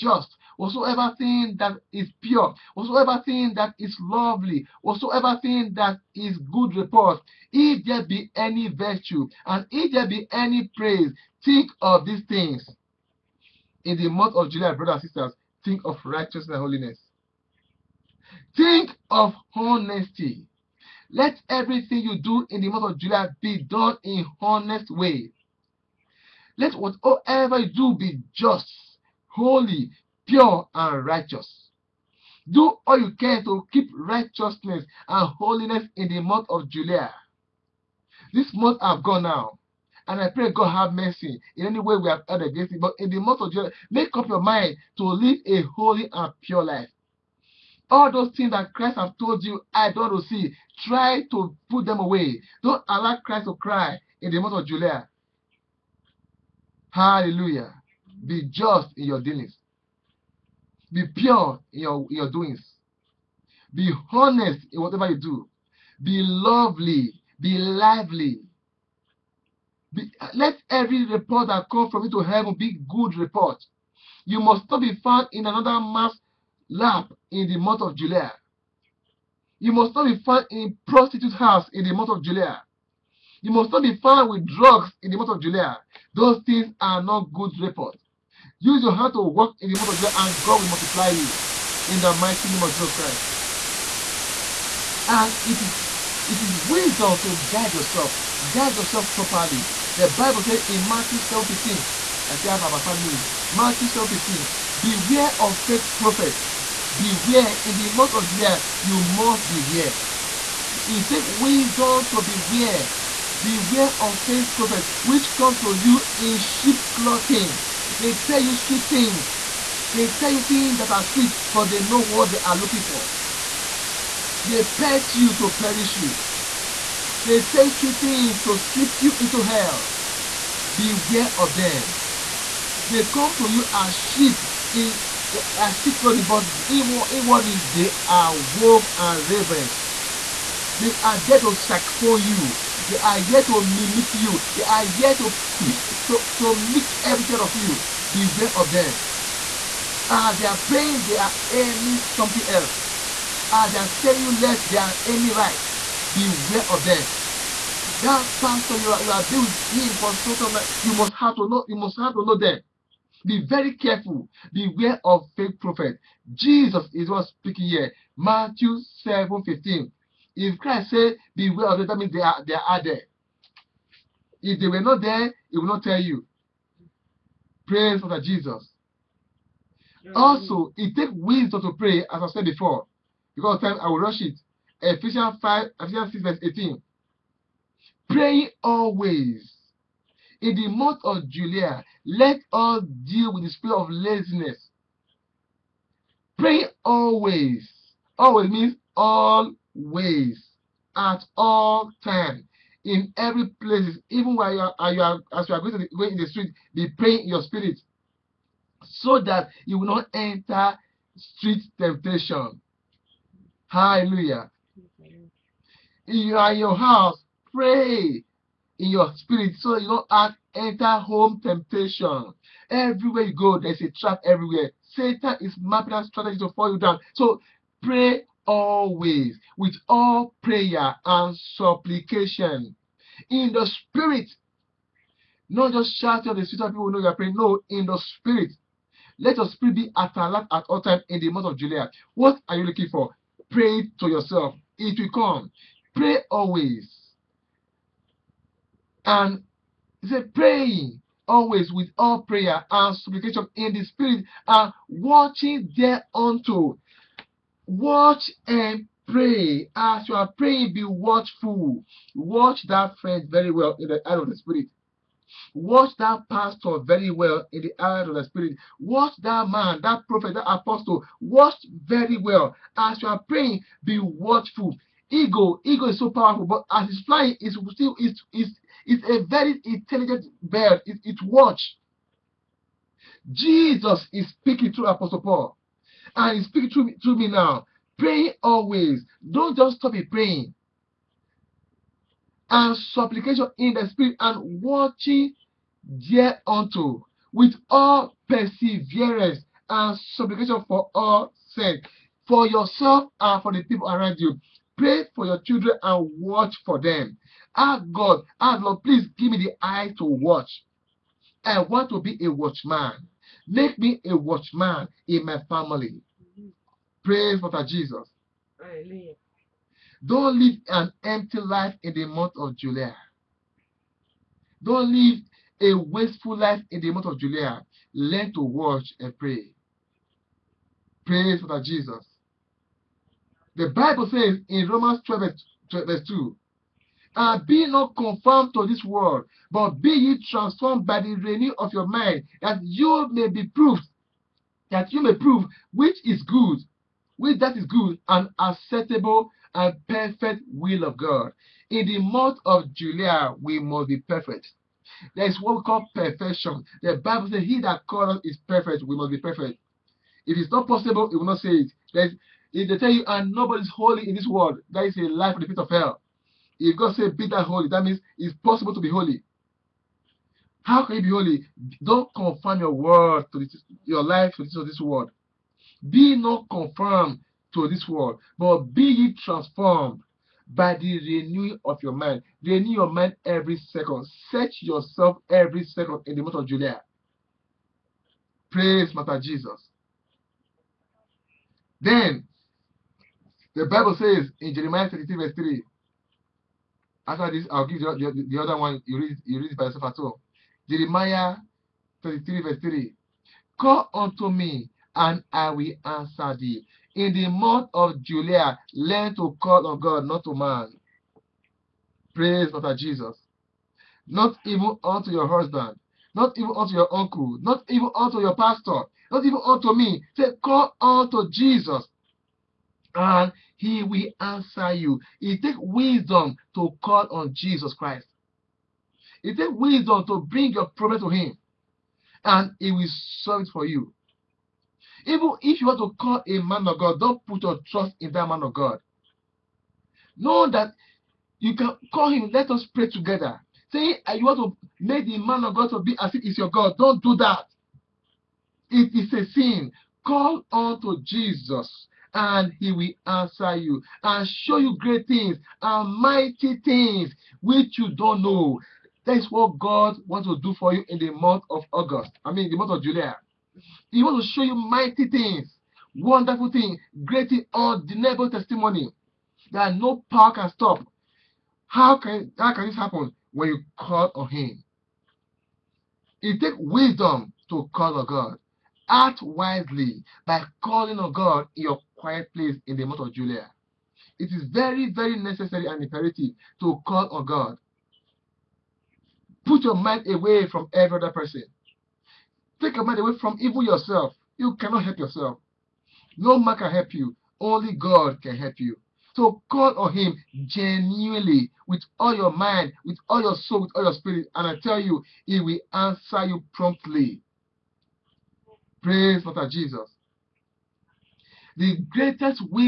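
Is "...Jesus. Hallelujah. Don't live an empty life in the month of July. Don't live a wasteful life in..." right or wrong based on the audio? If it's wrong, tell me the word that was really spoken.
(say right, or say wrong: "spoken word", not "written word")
right.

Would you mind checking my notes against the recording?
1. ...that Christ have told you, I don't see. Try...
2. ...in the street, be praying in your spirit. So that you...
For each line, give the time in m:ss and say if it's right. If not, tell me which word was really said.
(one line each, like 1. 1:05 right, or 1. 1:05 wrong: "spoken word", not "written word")
1. 0:48 right
2. 3:26 right.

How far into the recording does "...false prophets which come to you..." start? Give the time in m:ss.
1:54.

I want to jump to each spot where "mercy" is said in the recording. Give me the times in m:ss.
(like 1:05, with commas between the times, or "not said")
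0:40.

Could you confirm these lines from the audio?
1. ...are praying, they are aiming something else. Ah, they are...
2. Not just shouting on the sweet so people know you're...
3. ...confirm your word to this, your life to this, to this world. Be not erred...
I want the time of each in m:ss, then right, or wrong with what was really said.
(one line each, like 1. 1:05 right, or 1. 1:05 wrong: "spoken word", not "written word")
1. 2:30 right
2. 3:55 wrong: "street", not "sweet"
3. 6:12 wrong: "confirmed", not "erred".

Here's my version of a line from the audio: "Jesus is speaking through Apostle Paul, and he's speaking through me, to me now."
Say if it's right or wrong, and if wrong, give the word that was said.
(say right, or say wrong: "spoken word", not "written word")
right.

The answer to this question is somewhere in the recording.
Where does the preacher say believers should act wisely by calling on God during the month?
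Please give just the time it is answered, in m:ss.
8:01.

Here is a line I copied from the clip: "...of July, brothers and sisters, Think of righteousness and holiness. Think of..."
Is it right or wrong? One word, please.
right.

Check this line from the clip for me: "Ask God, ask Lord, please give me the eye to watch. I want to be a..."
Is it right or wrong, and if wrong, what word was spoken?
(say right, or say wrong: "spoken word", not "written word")
right.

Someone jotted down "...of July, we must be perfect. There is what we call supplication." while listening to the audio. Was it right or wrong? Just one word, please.
wrong.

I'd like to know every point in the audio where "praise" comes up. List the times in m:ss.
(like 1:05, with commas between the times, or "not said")
0:10, 2:57, 5:17, 6:28, 6:52, 8:28.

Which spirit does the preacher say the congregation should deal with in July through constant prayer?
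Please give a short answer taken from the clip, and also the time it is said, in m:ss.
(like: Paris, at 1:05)
laziness, at 3:13.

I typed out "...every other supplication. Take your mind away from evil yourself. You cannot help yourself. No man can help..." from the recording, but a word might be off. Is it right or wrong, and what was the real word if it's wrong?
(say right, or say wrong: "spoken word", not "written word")
wrong: "person", not "supplication".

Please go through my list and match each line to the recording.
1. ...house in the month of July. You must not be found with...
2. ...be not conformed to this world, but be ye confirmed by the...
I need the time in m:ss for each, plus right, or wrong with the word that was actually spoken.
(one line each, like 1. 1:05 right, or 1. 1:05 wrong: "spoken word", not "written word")
1. 1:21 right
2. 5:37 wrong: "transformed", not "confirmed".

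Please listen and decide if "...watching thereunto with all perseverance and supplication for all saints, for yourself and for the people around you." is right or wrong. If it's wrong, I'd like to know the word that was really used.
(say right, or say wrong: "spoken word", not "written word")
right.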